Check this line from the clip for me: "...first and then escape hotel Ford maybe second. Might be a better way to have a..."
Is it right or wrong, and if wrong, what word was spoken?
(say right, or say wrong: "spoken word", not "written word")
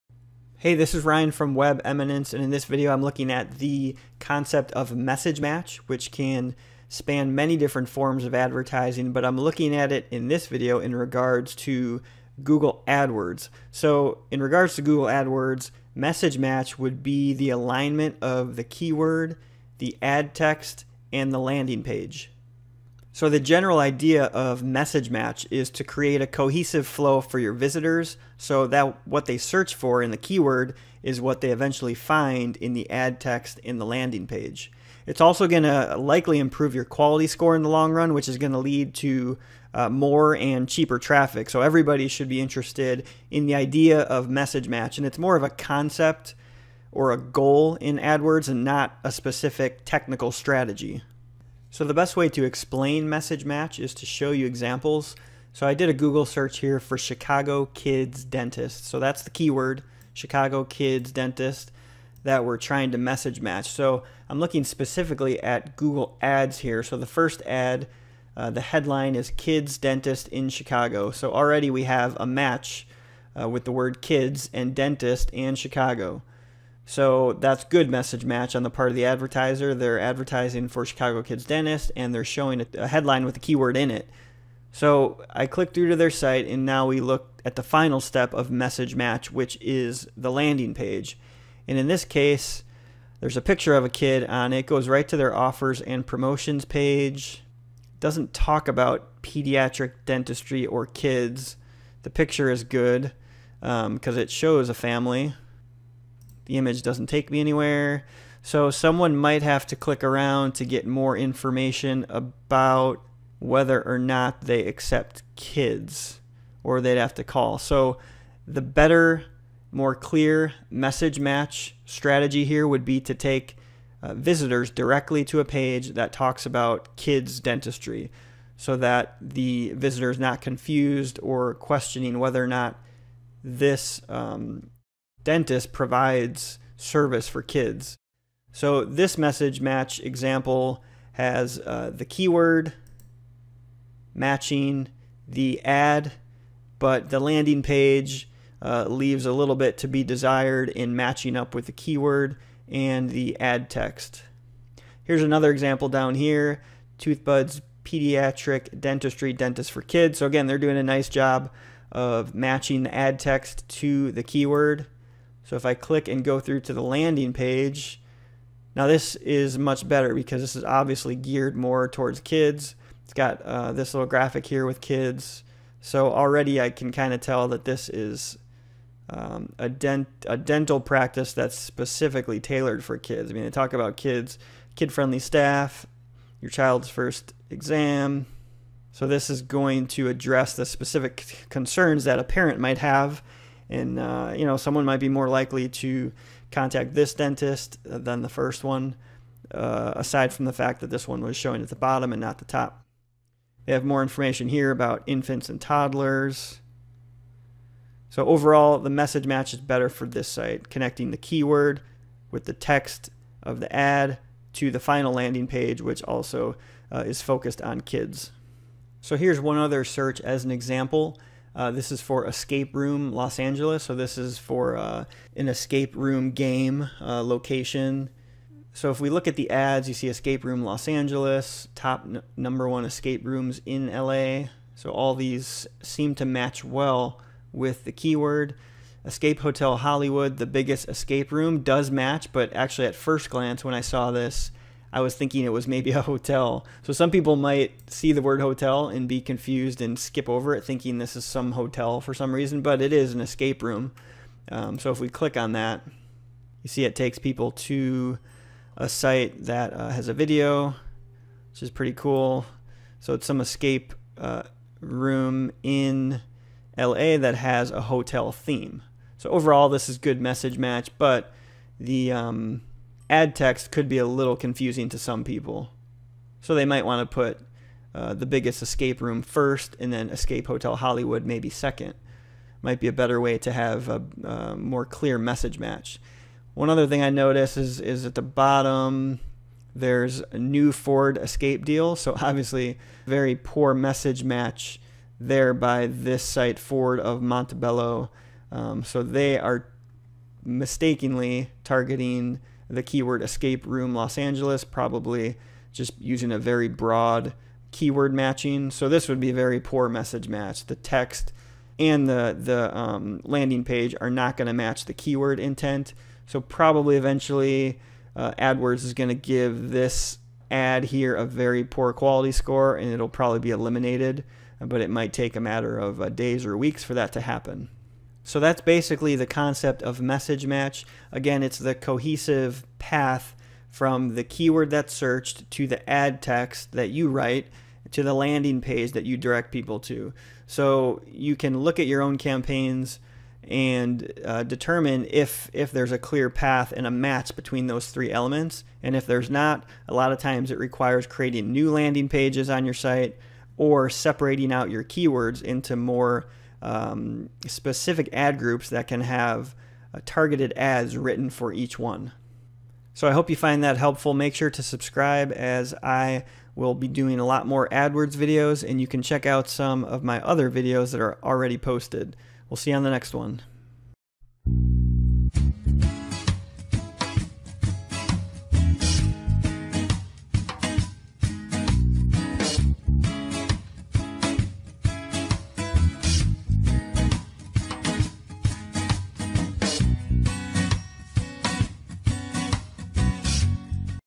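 wrong: "Hollywood", not "Ford".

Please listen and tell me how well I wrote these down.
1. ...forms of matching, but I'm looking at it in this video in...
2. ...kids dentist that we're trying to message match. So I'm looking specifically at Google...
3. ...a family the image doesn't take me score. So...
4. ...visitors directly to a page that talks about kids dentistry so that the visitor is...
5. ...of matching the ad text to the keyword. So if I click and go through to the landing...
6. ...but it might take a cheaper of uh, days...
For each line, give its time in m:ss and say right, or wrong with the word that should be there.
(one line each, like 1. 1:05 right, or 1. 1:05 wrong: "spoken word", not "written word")
1. 0:07 wrong: "advertising", not "matching"
2. 1:00 right
3. 1:44 wrong: "anywhere", not "score"
4. 2:04 right
5. 2:41 right
6. 5:24 wrong: "matter", not "cheaper".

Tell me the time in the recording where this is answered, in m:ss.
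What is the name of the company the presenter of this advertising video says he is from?
0:01.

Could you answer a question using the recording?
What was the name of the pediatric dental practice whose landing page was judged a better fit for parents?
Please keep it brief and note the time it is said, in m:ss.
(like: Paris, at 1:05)
Toothbud's, at 2:36.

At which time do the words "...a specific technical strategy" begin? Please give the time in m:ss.
0:49.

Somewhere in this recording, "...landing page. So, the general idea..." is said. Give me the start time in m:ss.
0:21.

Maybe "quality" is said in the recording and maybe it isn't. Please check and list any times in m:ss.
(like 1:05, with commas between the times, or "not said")
0:36, 5:21.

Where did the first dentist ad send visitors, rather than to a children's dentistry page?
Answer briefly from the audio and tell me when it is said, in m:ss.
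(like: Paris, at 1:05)
offers and promotions page, at 1:35.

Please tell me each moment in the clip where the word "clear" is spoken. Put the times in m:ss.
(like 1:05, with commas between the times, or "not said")
1:59, 4:44, 5:45.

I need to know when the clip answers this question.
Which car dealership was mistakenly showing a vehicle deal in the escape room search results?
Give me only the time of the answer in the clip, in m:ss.
4:56.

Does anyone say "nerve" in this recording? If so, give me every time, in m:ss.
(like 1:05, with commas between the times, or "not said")
not said.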